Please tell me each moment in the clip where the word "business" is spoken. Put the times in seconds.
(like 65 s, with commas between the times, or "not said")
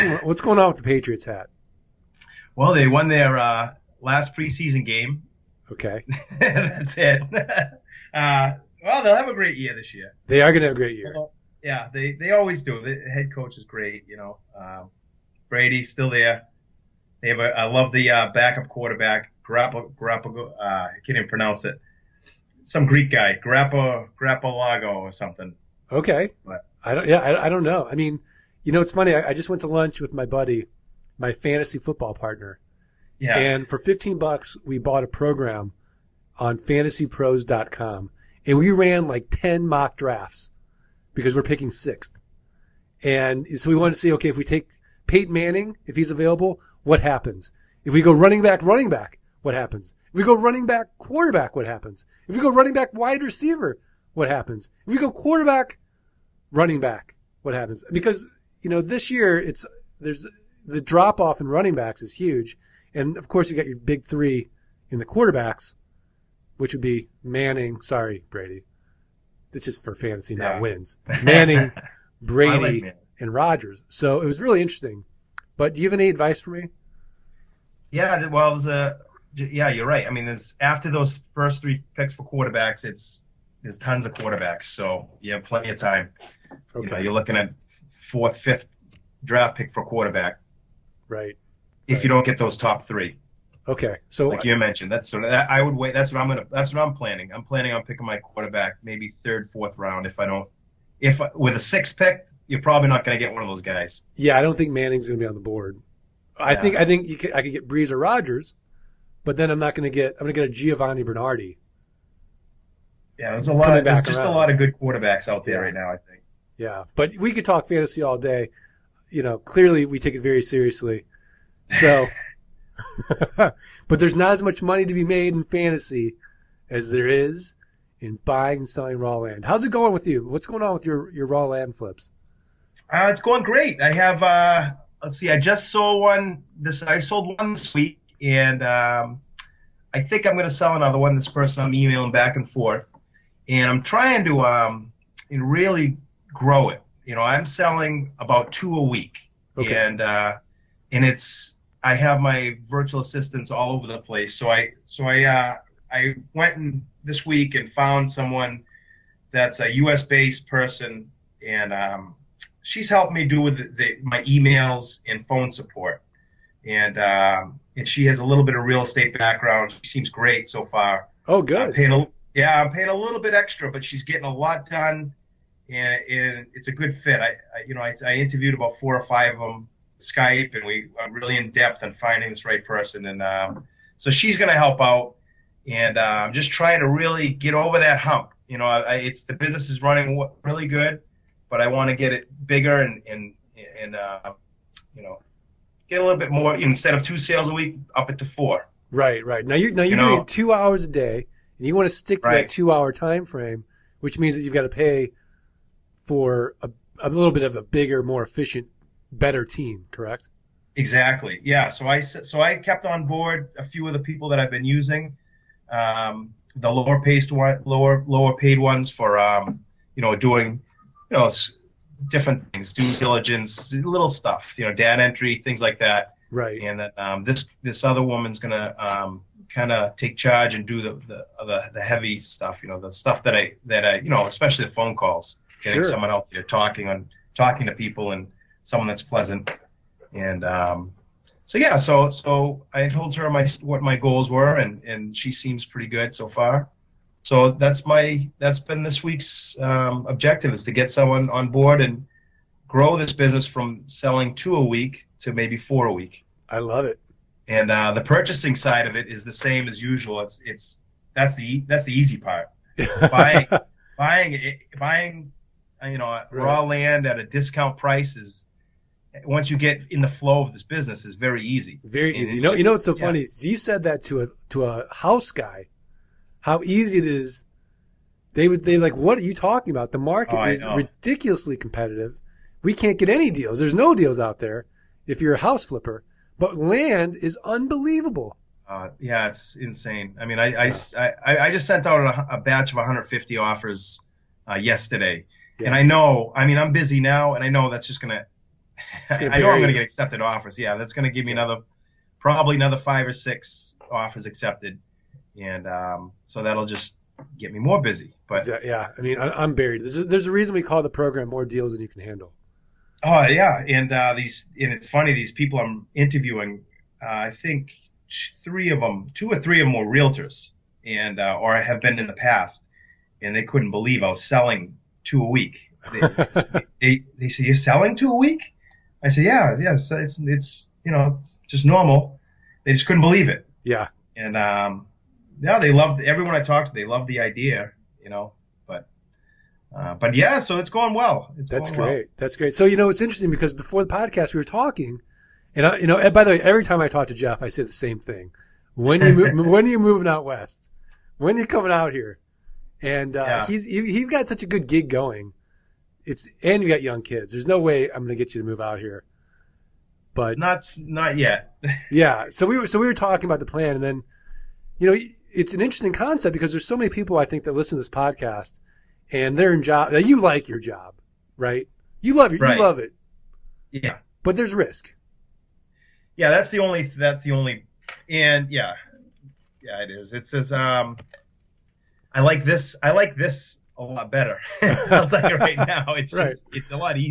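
189 s, 253 s, 270 s.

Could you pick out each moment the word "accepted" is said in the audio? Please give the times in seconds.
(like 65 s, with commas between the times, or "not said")
299 s, 304 s.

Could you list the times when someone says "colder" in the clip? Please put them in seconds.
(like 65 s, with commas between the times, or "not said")
not said.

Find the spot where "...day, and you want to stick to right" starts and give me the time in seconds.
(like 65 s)
200 s.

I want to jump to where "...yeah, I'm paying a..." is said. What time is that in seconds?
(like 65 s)
172 s.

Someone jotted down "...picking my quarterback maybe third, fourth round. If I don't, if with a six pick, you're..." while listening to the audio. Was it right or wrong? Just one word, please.
right.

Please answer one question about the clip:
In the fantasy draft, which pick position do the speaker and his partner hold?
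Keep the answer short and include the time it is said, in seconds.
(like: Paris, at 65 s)
sixth, at 41 s.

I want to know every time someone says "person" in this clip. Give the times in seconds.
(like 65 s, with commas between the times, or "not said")
141 s, 160 s, 182 s.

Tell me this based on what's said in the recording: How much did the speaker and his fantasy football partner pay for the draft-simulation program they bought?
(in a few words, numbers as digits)
$15.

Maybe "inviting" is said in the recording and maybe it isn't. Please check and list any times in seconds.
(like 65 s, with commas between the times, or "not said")
not said.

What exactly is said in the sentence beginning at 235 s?
someone out there talking on talking to people and someone that's pleasant.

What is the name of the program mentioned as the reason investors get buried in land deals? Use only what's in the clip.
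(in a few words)
More Deals Than You Can Handle.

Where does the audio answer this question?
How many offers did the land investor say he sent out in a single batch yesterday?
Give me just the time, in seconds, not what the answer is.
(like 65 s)
292 s.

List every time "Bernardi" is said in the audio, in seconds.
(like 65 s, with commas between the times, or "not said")
111 s.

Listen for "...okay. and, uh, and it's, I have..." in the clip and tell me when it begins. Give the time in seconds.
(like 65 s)
149 s.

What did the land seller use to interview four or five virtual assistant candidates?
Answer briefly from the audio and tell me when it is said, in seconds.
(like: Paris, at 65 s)
Skype, at 179 s.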